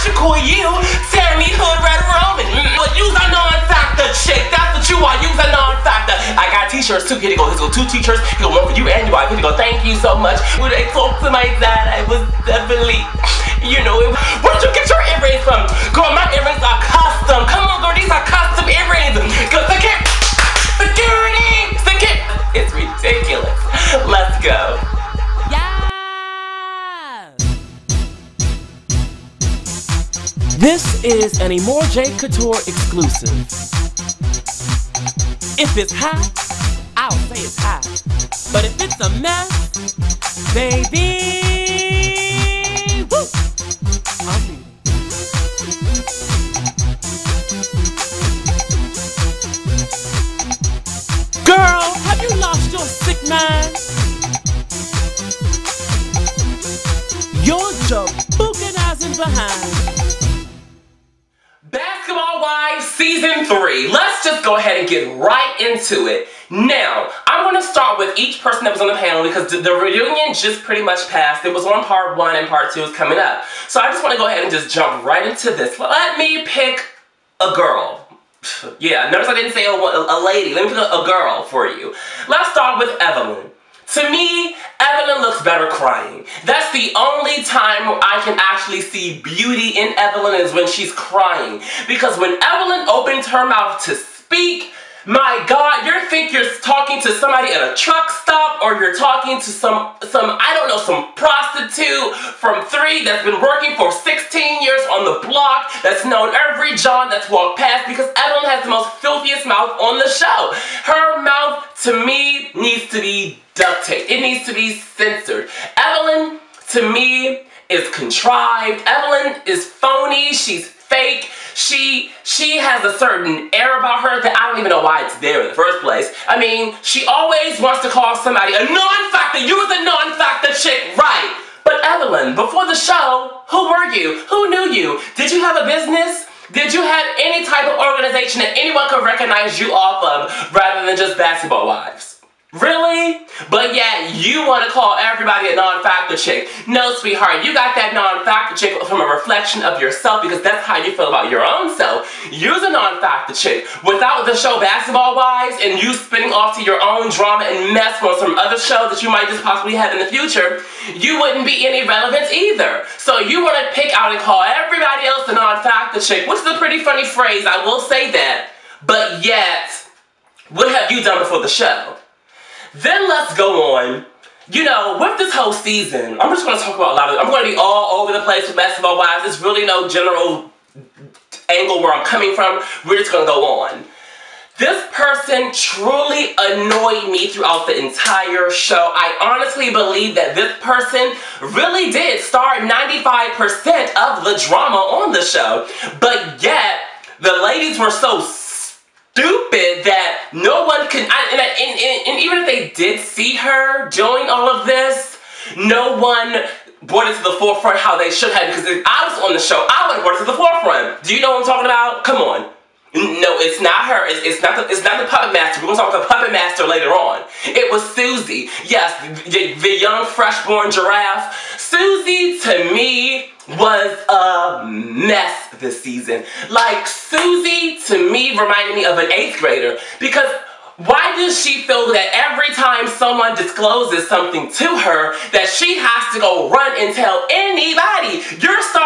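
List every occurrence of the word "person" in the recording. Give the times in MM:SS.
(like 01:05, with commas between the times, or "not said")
01:08, 03:04, 03:10.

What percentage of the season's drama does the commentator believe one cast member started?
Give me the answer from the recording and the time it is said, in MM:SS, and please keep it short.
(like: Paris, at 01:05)
95%, at 03:12.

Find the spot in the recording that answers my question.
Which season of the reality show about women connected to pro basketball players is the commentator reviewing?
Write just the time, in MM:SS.
01:02.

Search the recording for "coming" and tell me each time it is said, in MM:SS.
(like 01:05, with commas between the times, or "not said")
01:12, 03:02.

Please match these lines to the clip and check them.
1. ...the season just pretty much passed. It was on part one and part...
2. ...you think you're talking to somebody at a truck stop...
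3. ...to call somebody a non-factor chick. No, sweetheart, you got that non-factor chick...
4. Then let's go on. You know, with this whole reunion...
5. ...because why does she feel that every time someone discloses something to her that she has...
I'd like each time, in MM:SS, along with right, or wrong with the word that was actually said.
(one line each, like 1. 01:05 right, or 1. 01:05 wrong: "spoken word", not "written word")
1. 01:09 wrong: "reunion", not "season"
2. 01:35 right
3. 02:24 wrong: "everybody", not "somebody"
4. 02:52 wrong: "season", not "reunion"
5. 03:50 right.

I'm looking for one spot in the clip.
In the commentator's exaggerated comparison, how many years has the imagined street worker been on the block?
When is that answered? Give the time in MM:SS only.
01:43.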